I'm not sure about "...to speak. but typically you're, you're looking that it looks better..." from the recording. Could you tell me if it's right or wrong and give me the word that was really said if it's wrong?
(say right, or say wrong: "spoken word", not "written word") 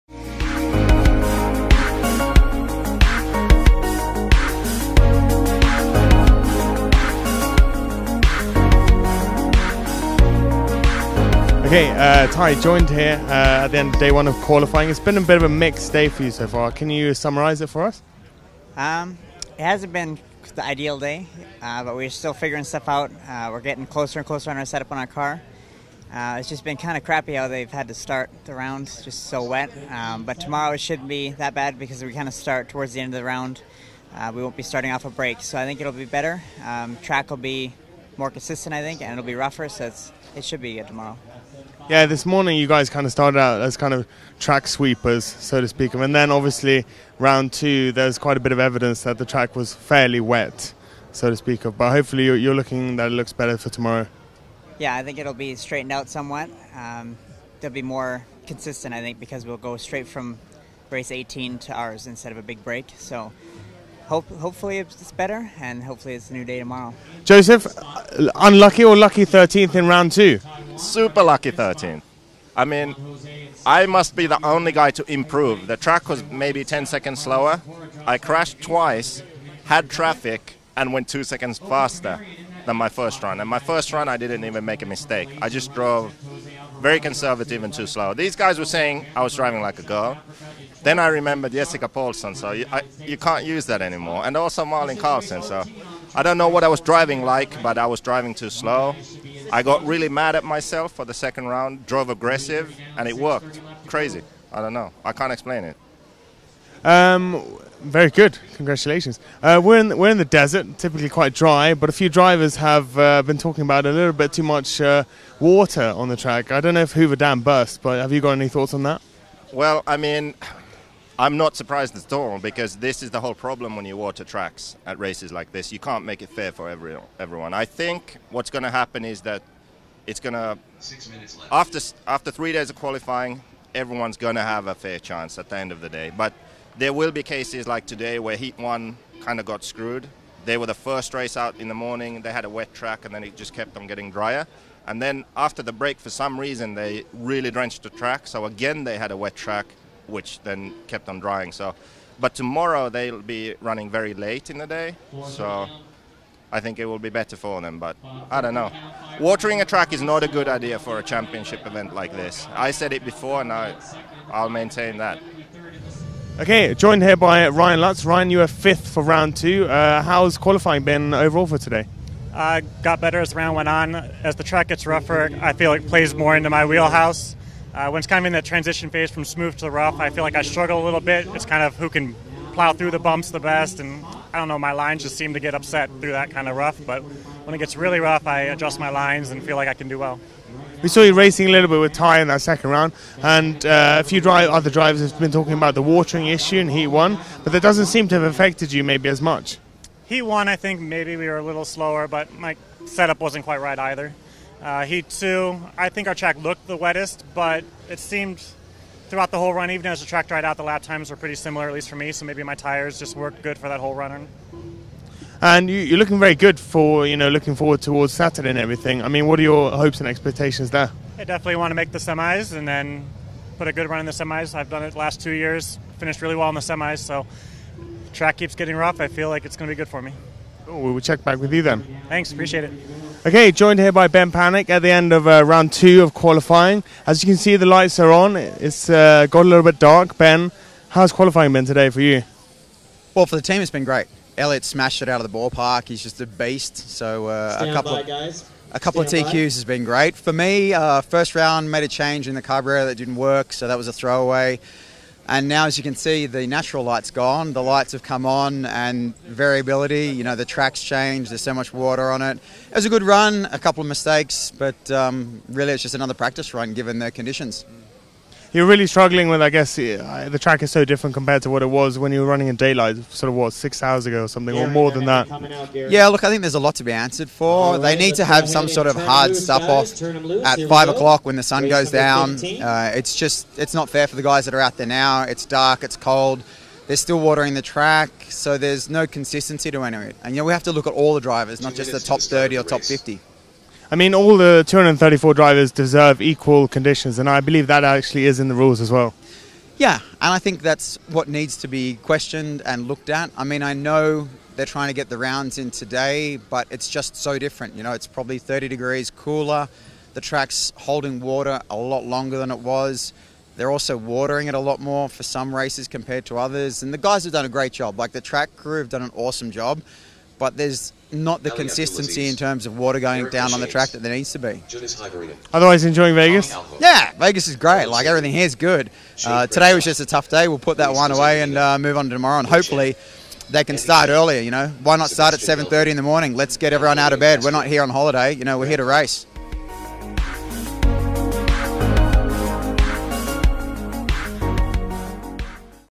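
wrong: "hopefully", not "typically".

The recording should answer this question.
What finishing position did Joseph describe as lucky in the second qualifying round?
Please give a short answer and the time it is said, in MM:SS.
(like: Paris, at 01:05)
13th, at 01:09.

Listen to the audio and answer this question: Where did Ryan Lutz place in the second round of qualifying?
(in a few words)
Fifth.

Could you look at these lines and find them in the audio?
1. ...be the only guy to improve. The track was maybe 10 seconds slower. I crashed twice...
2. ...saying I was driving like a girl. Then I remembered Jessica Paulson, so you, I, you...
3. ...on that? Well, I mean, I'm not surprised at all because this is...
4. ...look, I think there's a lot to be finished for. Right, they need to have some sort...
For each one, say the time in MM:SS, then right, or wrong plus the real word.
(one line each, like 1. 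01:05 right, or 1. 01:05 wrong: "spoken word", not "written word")
1. 01:14 right
2. 01:28 right
3. 01:58 right
4. 04:36 wrong: "answered", not "finished".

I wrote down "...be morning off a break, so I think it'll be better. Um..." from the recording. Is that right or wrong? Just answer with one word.
wrong.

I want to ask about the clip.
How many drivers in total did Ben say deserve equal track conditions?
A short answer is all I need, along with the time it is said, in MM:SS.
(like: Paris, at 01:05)
234, at 04:54.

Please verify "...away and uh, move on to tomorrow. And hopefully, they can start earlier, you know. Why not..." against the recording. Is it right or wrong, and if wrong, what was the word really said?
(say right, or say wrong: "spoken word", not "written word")
right.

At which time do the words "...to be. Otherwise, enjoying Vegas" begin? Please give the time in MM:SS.
05:24.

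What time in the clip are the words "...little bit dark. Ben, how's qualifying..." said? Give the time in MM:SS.
03:59.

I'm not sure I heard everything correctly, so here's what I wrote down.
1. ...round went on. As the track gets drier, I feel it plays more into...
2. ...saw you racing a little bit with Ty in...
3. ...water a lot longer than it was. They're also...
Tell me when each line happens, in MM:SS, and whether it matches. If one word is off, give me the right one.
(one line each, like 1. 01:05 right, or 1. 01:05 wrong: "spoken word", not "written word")
1. 02:53 wrong: "rougher", not "drier"
2. 03:10 right
3. 05:11 right.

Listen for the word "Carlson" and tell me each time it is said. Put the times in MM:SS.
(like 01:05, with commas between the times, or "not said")
01:34.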